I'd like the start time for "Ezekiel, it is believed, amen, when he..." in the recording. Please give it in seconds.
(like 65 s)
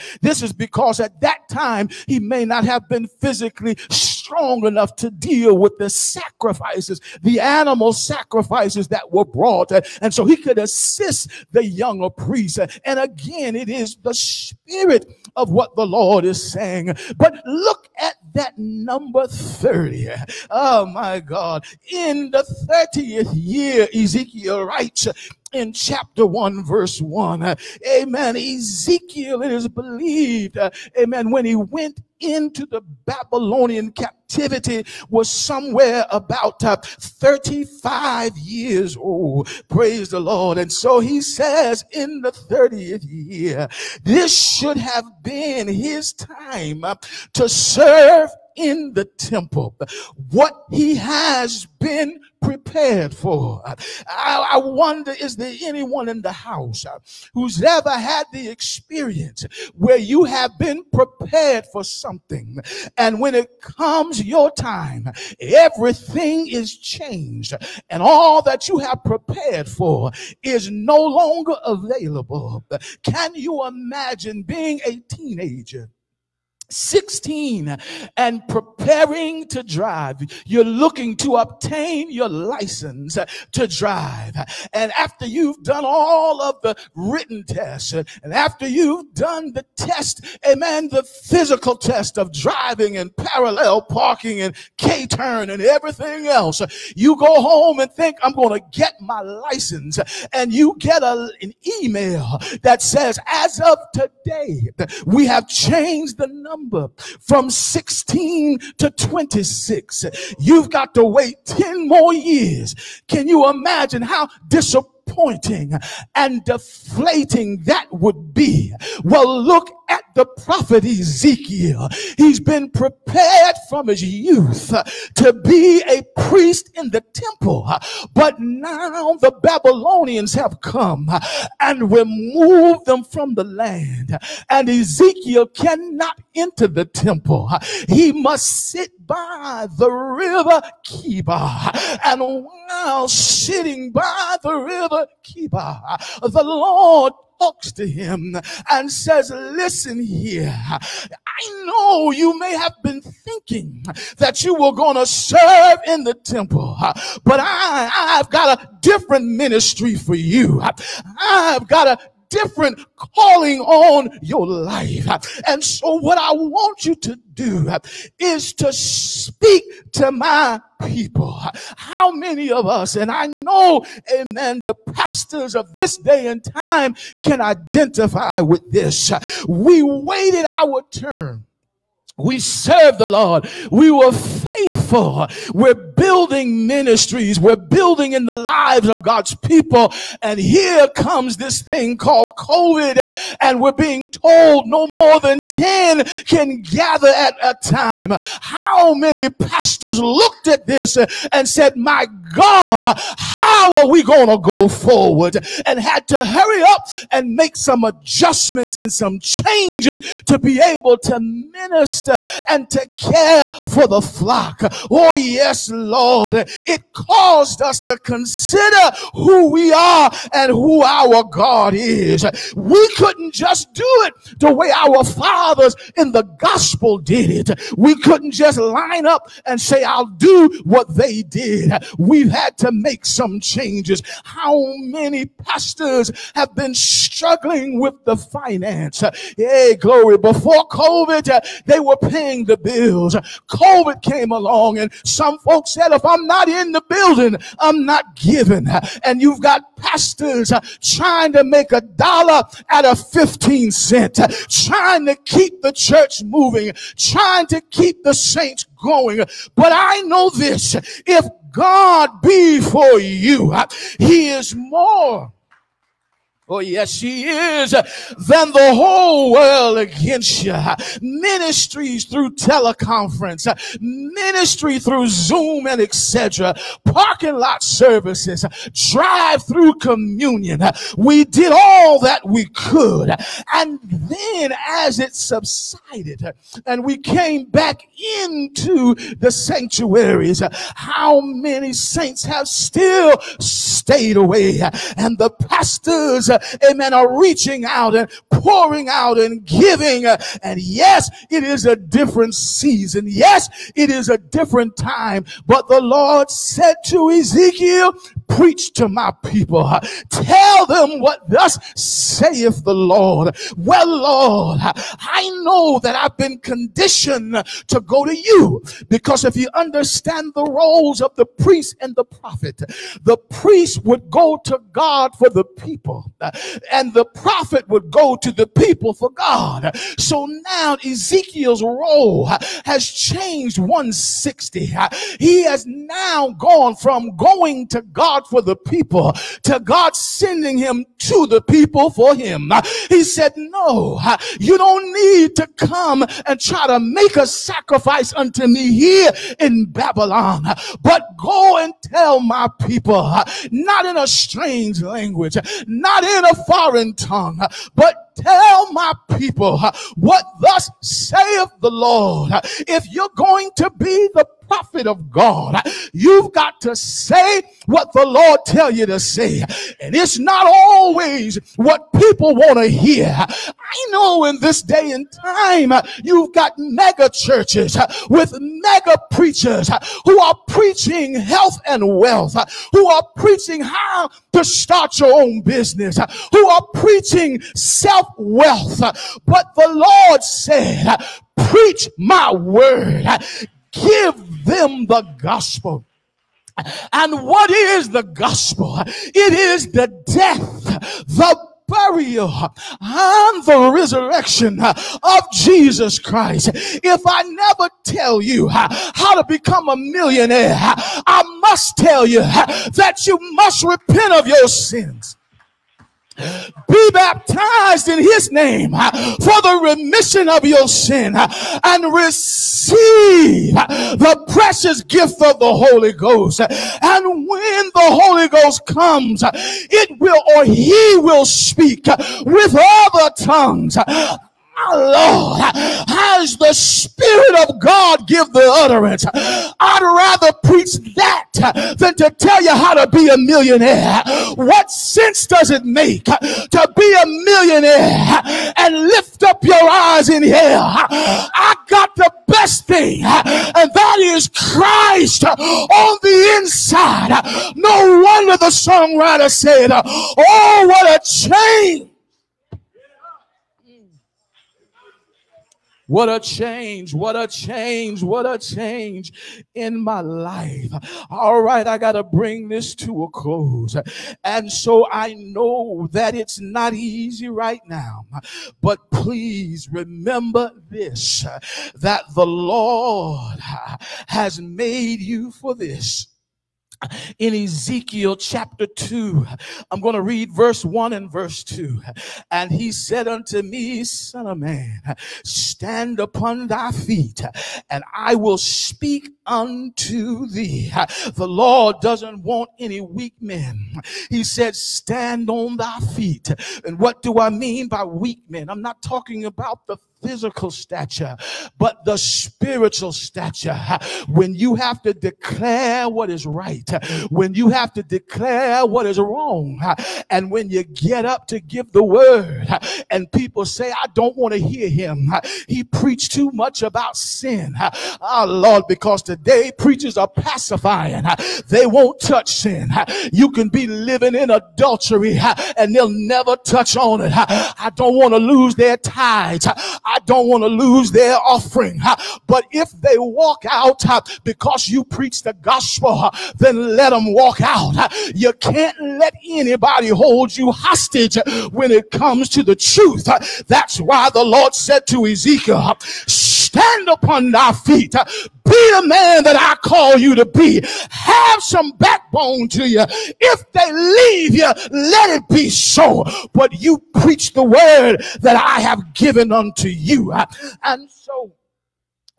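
28 s.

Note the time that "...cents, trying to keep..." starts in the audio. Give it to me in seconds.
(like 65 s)
253 s.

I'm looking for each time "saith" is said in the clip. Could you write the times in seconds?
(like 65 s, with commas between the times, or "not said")
311 s, 360 s.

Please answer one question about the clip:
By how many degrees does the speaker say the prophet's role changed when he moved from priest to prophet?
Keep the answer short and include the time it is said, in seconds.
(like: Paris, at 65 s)
160, at 333 s.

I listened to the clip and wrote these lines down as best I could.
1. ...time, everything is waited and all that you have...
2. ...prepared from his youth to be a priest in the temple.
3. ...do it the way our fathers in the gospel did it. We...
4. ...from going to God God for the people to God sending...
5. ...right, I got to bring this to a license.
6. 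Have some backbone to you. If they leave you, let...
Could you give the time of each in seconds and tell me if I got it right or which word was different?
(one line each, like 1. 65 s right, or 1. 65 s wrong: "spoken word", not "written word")
1. 64 s wrong: "changed", not "waited"
2. 122 s right
3. 223 s right
4. 336 s right
5. 471 s wrong: "close", not "license"
6. 560 s right.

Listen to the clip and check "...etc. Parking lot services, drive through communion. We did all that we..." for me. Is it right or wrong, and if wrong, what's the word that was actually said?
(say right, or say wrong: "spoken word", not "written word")
right.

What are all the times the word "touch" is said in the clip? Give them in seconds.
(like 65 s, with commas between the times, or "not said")
531 s, 536 s.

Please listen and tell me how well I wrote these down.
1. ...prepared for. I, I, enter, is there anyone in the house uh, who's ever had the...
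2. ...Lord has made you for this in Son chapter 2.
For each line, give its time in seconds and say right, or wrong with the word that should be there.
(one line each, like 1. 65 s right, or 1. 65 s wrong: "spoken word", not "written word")
1. 52 s wrong: "wonder", not "enter"
2. 482 s wrong: "Ezekiel", not "Son".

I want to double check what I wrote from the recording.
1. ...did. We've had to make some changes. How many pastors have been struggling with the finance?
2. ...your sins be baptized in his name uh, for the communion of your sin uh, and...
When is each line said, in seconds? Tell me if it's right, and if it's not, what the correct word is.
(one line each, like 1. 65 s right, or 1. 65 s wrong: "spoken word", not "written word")
1. 231 s right
2. 414 s wrong: "remission", not "communion".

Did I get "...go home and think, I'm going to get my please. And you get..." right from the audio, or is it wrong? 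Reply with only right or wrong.
wrong.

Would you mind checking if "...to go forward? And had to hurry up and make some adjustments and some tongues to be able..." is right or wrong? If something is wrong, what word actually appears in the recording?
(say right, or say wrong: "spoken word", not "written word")
wrong: "changes", not "tongues".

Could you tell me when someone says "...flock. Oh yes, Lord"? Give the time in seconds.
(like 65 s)
214 s.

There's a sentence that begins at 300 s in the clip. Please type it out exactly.
Uh, and yes, it is a different season.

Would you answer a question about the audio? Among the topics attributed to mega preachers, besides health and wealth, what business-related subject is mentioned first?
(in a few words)
How to start your own business.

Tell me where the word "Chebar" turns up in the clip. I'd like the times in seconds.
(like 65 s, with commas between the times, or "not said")
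140 s, 145 s.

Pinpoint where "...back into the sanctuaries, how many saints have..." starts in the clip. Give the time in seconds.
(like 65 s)
287 s.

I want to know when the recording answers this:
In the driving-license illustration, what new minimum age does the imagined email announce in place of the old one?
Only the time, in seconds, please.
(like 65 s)
108 s.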